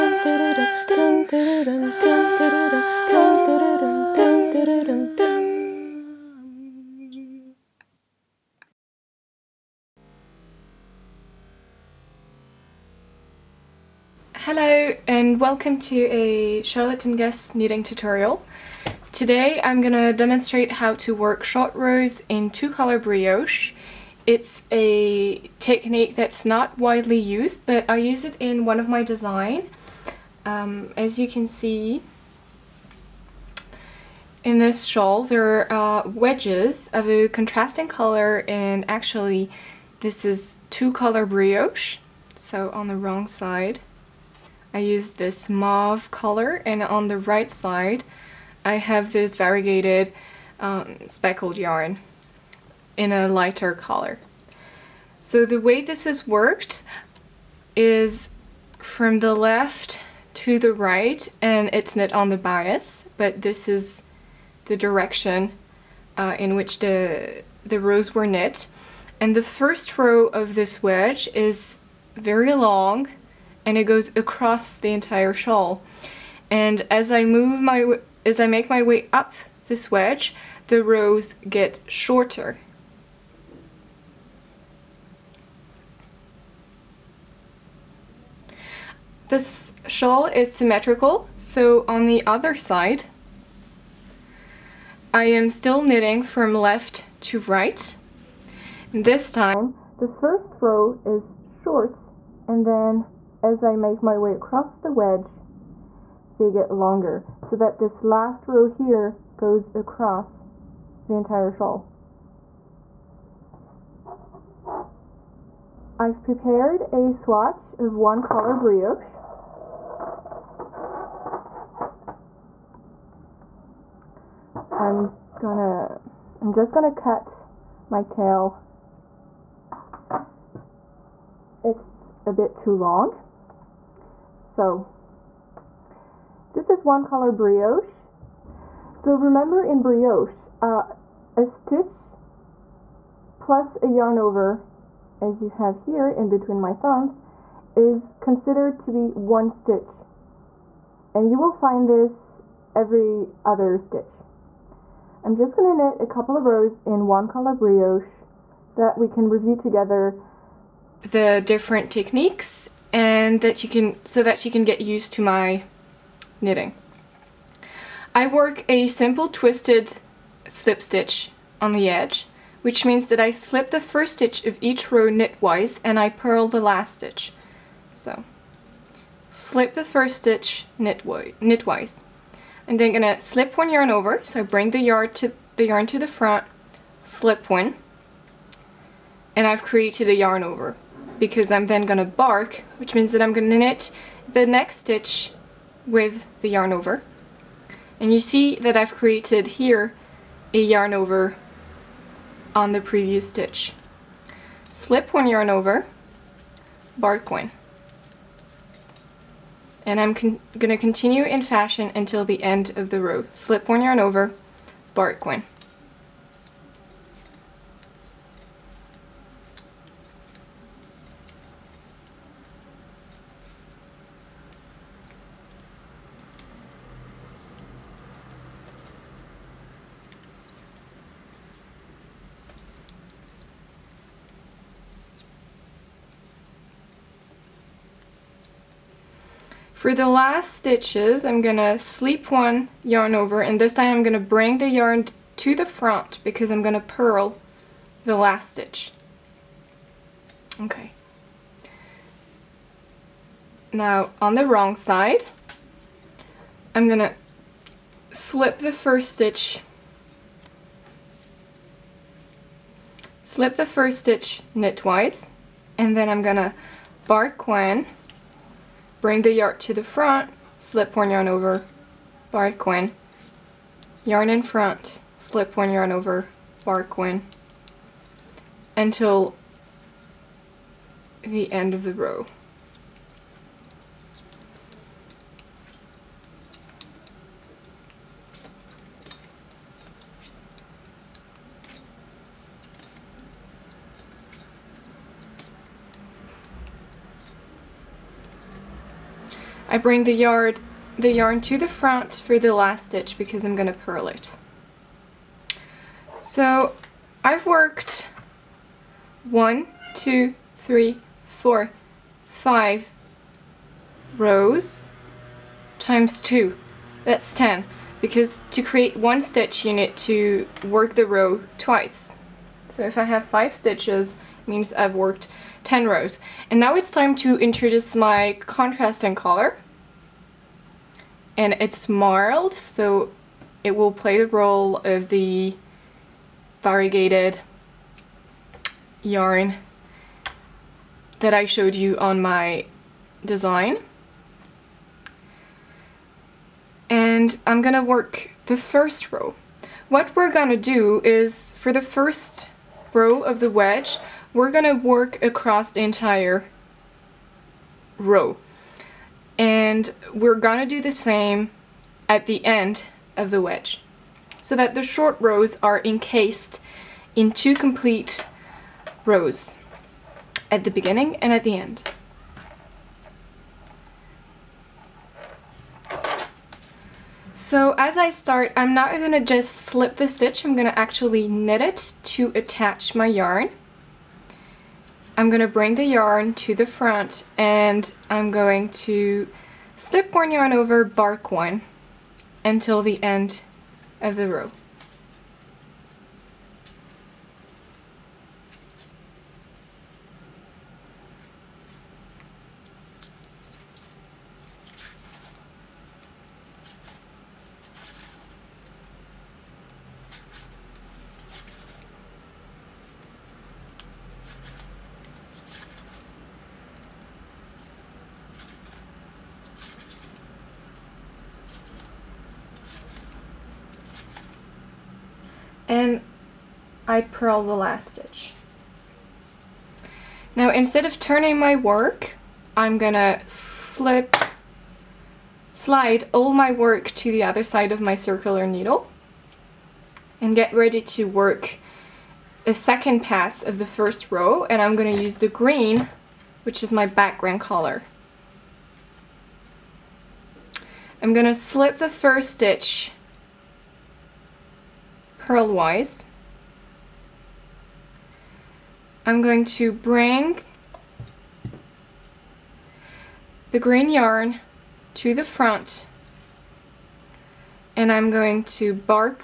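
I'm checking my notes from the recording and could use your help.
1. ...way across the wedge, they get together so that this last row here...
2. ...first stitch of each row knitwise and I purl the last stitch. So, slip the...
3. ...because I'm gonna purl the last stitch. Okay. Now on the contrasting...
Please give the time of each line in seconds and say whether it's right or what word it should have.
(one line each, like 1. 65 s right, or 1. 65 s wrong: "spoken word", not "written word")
1. 104 s wrong: "longer", not "together"
2. 173 s right
3. 246 s wrong: "wrong", not "contrasting".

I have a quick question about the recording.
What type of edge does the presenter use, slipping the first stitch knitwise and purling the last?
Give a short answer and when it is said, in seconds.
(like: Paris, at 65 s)
Twisted slip stitch, at 169 s.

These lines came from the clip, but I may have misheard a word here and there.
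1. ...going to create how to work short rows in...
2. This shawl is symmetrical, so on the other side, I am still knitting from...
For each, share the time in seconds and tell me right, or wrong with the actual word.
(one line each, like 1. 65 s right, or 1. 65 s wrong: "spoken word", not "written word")
1. 19 s wrong: "demonstrate", not "create"
2. 89 s right.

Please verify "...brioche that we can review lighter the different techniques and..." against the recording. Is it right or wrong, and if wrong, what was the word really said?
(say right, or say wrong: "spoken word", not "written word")
wrong: "together", not "lighter".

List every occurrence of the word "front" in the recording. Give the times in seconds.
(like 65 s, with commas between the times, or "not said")
186 s, 245 s, 269 s, 274 s, 301 s, 386 s, 465 s.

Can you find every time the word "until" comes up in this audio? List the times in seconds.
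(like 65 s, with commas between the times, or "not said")
211 s, 278 s, 392 s.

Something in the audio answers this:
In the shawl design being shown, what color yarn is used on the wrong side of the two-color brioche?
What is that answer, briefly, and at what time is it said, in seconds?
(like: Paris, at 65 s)
Mauve, at 45 s.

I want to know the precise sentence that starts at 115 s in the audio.
I've prepared a swatch of one color brioche.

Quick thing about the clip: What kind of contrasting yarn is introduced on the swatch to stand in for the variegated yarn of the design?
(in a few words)
Marled.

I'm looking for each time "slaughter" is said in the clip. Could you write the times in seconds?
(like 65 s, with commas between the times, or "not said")
not said.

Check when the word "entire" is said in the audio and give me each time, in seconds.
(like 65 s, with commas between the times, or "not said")
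74 s, 111 s, 355 s.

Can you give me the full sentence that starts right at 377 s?
So as I start, I'm not going to just slip the stitch, I'm going to actually knit it to attach my yarn.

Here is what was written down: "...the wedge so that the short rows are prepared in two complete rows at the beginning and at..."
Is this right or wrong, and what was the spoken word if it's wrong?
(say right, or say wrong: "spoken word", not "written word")
wrong: "encased", not "prepared".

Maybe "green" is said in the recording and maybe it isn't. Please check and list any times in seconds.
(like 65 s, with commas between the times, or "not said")
445 s, 463 s.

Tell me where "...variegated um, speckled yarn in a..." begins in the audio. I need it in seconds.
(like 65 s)
49 s.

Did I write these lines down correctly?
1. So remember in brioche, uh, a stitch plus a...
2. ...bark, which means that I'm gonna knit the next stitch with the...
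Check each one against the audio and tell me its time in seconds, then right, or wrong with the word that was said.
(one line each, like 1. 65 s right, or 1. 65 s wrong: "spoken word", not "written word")
1. 138 s right
2. 192 s right.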